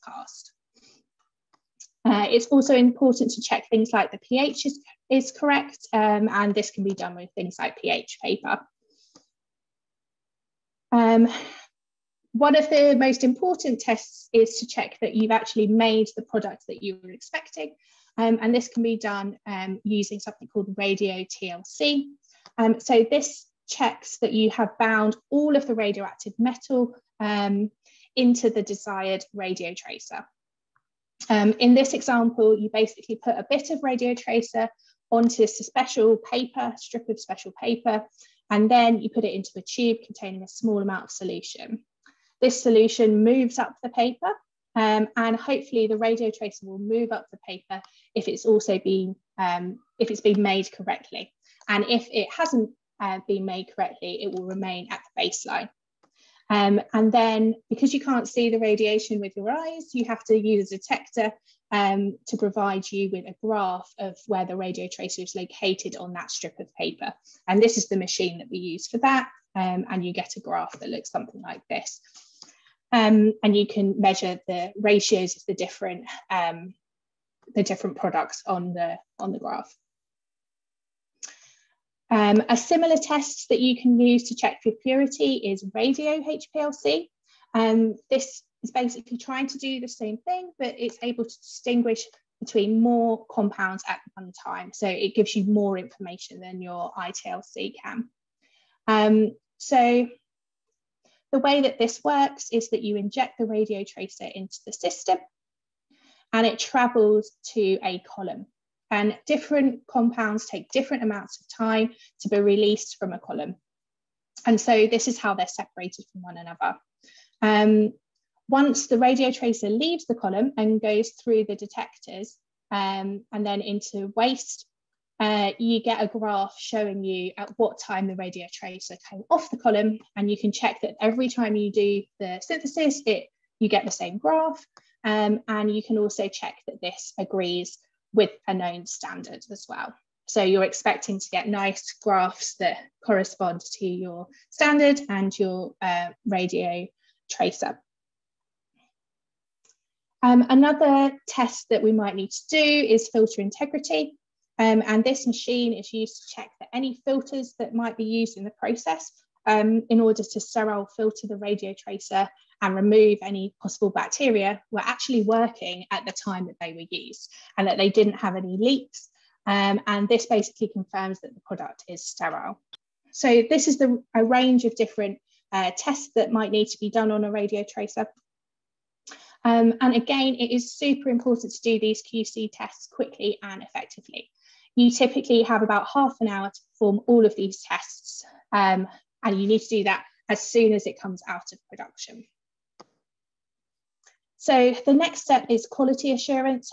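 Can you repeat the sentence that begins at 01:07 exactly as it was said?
And this is the machine that we use for that.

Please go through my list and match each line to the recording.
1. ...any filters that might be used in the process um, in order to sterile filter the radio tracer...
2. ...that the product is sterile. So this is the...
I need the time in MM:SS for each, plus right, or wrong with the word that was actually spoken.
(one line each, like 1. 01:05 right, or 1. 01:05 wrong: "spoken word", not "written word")
1. 02:36 right
2. 02:51 right.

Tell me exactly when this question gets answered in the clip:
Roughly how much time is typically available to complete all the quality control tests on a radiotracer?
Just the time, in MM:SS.
03:05.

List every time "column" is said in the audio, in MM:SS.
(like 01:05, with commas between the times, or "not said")
01:47, 01:53, 02:00, 02:09.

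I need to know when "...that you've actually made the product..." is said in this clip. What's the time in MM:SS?
00:15.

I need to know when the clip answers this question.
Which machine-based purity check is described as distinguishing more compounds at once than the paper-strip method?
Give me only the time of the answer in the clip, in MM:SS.
01:25.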